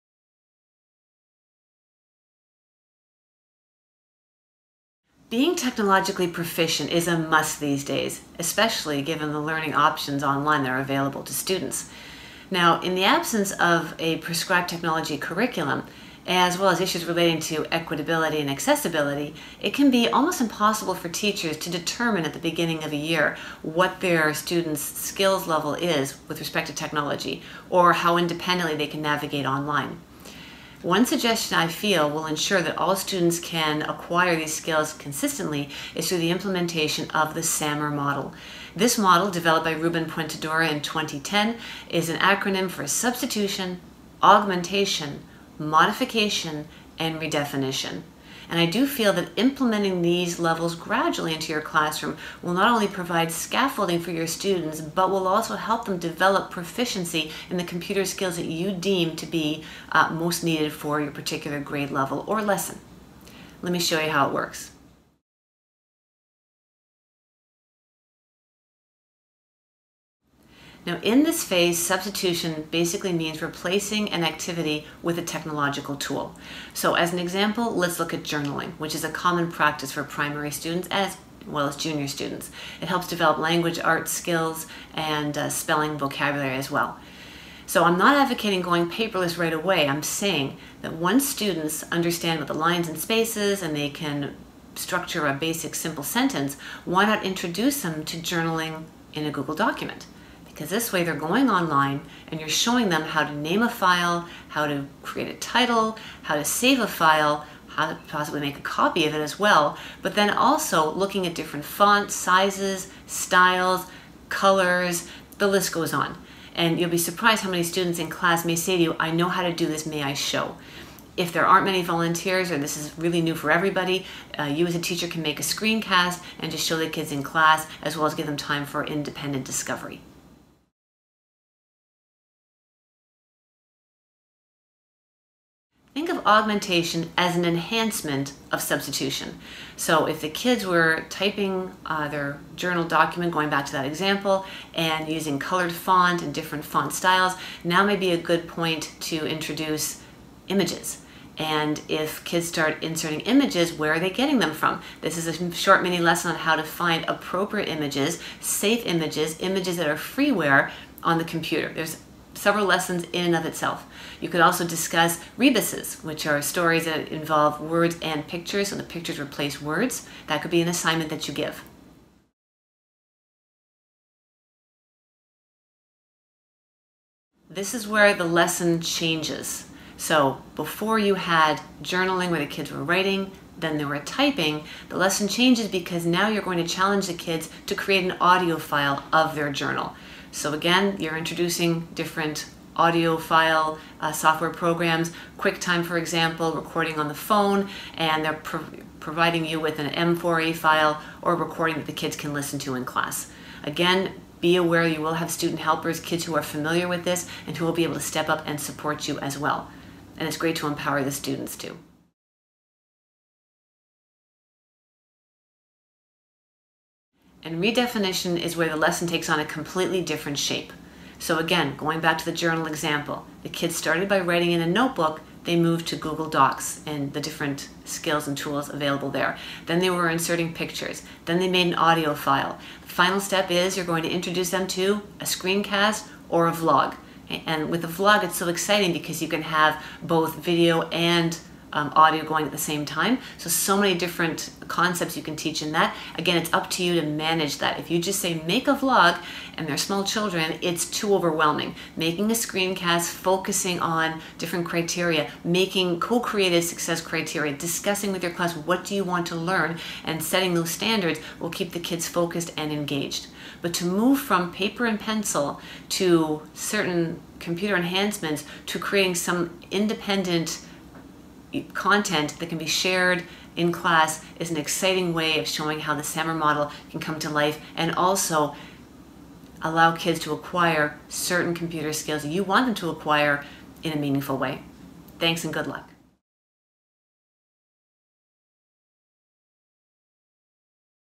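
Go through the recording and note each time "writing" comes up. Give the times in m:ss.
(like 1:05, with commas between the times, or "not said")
3:02, 3:44.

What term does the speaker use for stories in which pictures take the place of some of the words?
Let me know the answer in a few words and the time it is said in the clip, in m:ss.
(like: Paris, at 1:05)
rebuses, at 2:45.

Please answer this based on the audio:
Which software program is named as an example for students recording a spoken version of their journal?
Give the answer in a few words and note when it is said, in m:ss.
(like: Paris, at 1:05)
QuickTime, at 3:15.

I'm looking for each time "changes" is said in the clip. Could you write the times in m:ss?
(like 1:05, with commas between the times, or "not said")
2:58, 3:05.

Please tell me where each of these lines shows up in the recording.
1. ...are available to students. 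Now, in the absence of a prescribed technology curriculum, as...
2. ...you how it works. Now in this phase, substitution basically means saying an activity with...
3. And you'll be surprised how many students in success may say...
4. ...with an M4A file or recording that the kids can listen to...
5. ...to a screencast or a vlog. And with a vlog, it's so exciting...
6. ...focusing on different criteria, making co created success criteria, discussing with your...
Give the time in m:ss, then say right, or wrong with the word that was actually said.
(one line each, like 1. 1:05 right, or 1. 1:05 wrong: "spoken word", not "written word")
1. 0:10 right
2. 1:04 wrong: "replacing", not "saying"
3. 1:56 wrong: "class", not "success"
4. 3:19 right
5. 3:54 right
6. 4:13 right.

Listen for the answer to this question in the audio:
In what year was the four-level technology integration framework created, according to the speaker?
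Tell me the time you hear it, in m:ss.
0:40.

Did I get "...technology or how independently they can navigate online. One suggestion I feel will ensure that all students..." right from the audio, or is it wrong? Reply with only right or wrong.
right.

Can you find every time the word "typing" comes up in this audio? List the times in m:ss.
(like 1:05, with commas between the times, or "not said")
2:21, 3:03.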